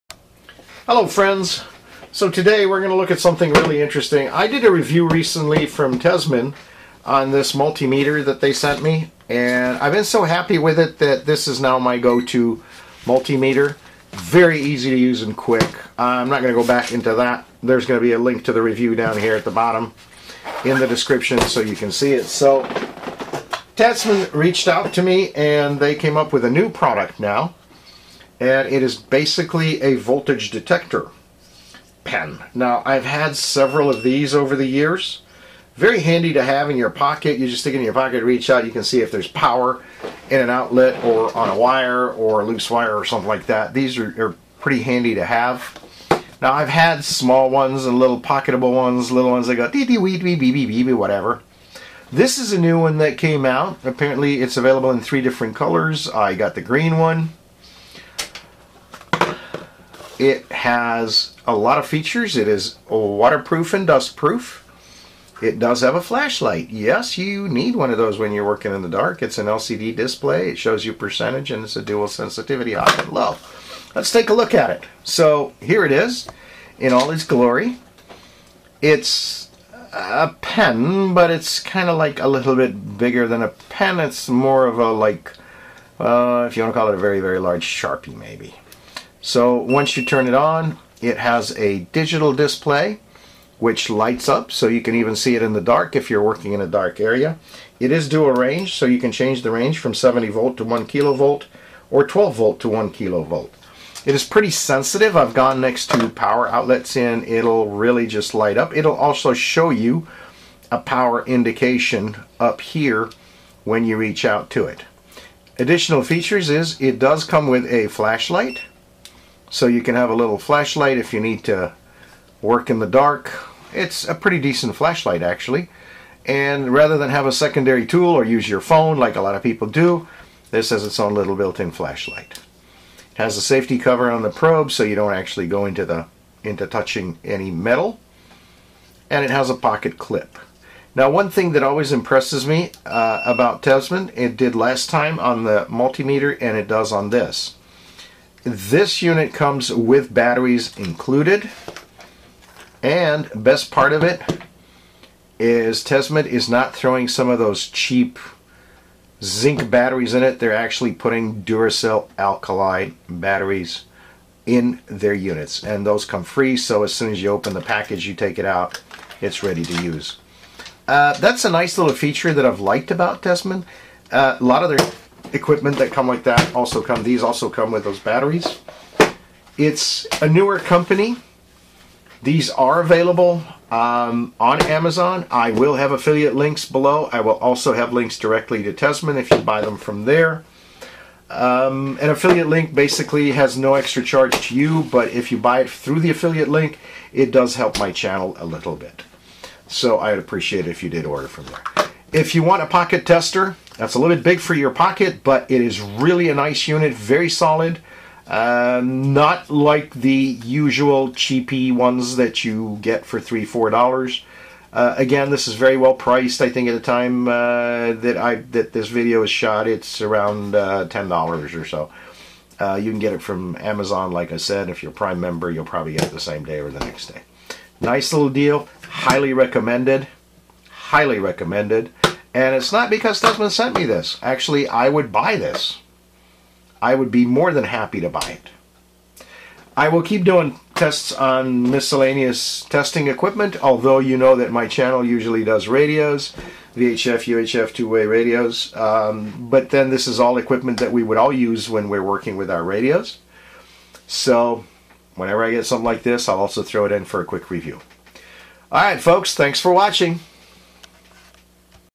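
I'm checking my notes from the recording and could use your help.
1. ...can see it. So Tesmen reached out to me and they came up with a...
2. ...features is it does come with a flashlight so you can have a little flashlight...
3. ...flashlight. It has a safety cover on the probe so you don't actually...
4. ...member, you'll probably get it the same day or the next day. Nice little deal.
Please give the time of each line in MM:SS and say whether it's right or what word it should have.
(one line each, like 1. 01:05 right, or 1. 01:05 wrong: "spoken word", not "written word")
1. 00:21 right
2. 01:56 right
3. 02:11 right
4. 03:45 right.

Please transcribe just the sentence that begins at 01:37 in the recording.
It is dual range so you can change the range from 70 volt to 1 kilovolt or 12 volt to 1 kilovolt.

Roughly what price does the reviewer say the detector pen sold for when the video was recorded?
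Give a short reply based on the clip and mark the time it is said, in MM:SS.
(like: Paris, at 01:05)
$10, at 03:40.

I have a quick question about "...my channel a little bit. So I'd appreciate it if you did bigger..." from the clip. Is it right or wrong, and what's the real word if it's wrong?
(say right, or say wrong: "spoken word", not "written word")
wrong: "order", not "bigger".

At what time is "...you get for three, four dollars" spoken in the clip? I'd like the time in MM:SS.
03:32.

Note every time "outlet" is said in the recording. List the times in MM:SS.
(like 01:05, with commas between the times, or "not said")
00:40, 01:46.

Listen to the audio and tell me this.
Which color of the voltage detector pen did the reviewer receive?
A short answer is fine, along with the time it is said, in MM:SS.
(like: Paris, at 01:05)
Green, at 00:56.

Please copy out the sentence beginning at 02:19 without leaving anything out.
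And it has a pocket clip.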